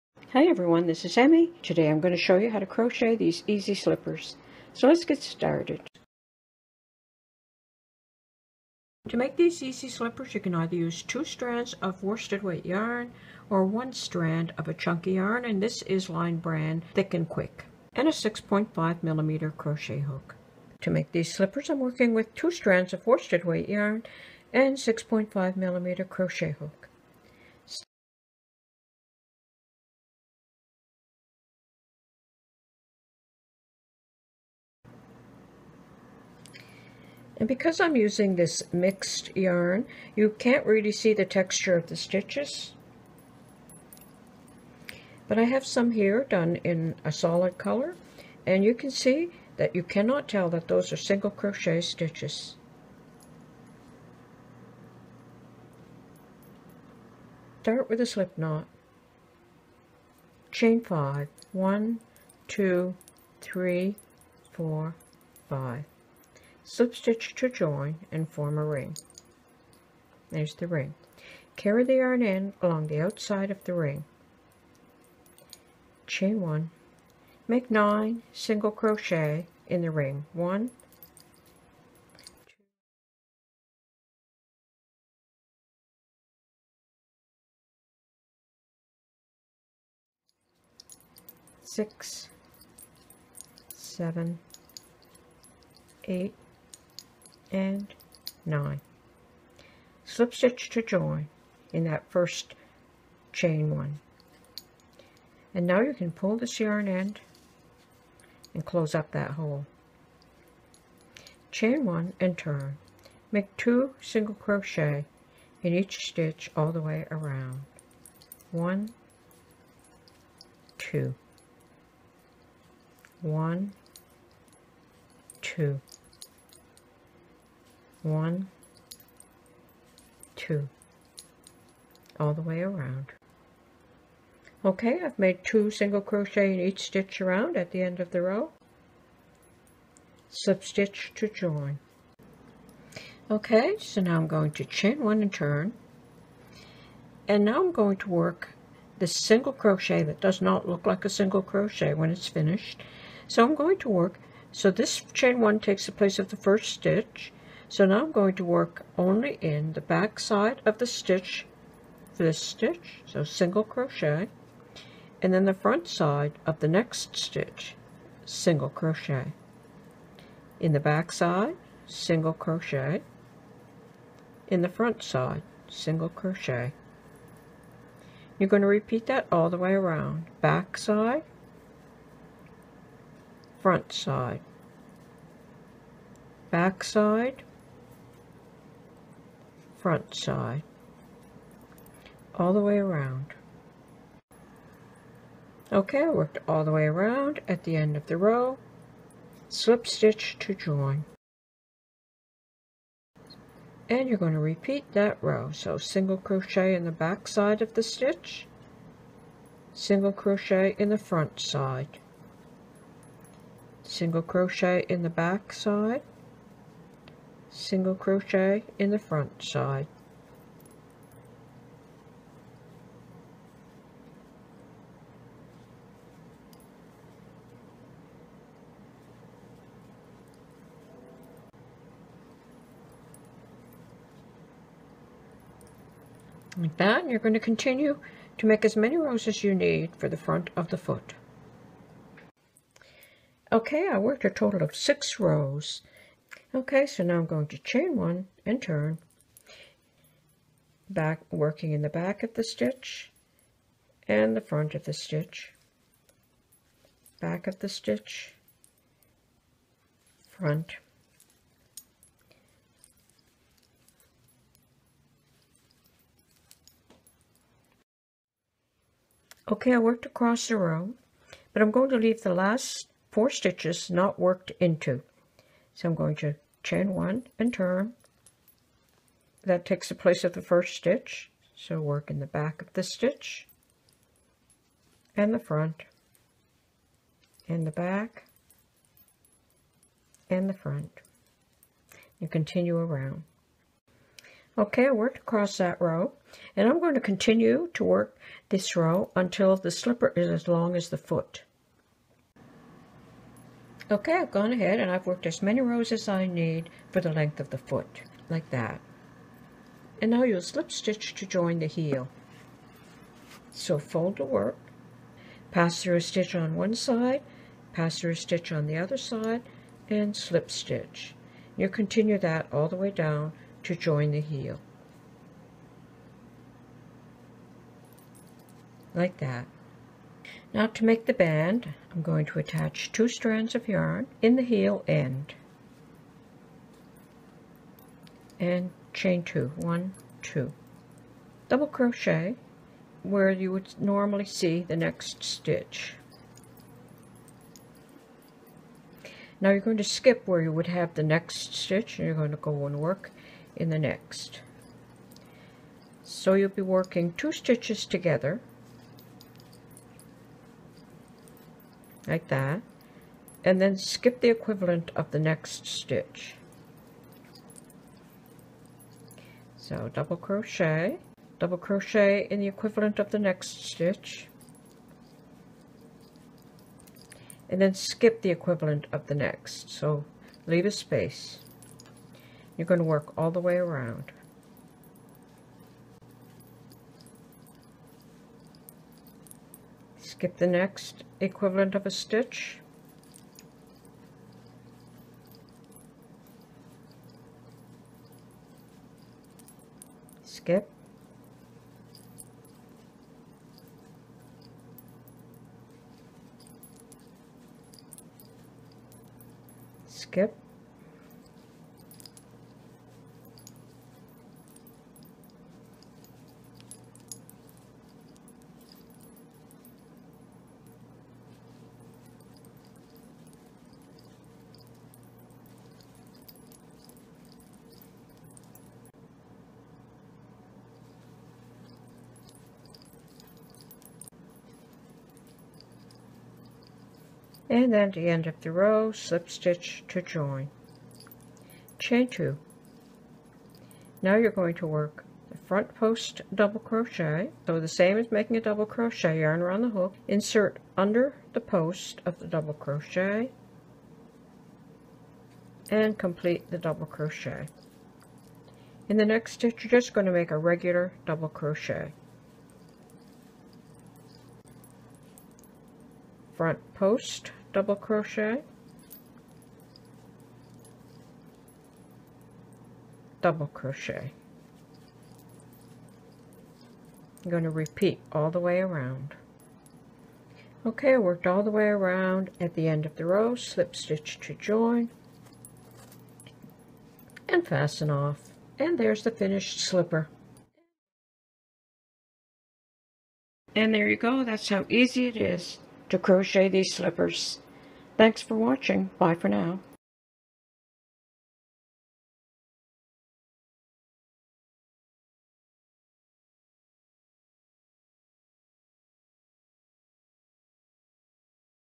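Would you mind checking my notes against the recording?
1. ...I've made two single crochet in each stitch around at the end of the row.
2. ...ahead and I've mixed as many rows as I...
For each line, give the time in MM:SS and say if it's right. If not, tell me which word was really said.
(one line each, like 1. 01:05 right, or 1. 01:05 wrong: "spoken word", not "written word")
1. 02:15 right
2. 05:04 wrong: "worked", not "mixed".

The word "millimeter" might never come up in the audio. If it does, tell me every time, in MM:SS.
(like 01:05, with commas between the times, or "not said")
00:19, 00:25.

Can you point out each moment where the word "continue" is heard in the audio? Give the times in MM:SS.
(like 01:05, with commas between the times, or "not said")
03:57, 04:52, 04:57, 05:21.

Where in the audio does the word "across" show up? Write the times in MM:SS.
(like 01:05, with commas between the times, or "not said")
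04:30, 04:55.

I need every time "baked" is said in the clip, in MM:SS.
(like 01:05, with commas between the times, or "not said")
not said.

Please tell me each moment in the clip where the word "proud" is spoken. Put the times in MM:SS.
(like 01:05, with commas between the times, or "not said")
not said.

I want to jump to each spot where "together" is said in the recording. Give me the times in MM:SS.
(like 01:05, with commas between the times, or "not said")
05:57.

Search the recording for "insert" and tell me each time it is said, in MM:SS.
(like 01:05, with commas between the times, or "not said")
07:30.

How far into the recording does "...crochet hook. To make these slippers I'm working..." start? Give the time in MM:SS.
00:19.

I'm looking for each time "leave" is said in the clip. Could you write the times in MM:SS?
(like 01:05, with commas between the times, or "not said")
04:31, 06:20.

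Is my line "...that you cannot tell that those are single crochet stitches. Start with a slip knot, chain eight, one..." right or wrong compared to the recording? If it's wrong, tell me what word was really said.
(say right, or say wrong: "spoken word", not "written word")
wrong: "five", not "eight".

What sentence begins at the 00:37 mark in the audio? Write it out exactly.
And because I'm using this mixed yarn, you can't really see the texture of the stitches.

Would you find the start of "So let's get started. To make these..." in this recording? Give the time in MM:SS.
00:04.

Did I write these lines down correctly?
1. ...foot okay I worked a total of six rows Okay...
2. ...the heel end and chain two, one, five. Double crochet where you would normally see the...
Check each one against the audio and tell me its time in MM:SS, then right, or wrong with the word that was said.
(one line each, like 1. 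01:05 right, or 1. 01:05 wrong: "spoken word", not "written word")
1. 04:00 right
2. 05:34 wrong: "two", not "five".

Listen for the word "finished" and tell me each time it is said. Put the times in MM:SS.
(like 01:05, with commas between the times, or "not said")
02:32, 08:09.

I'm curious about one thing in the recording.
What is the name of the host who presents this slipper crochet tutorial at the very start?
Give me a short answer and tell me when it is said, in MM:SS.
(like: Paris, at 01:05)
Emi, at 00:01.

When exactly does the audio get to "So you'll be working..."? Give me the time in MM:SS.
05:56.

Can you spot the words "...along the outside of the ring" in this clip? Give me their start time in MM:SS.
01:12.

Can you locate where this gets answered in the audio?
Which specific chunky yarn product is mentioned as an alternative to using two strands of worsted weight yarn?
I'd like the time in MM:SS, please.
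00:16.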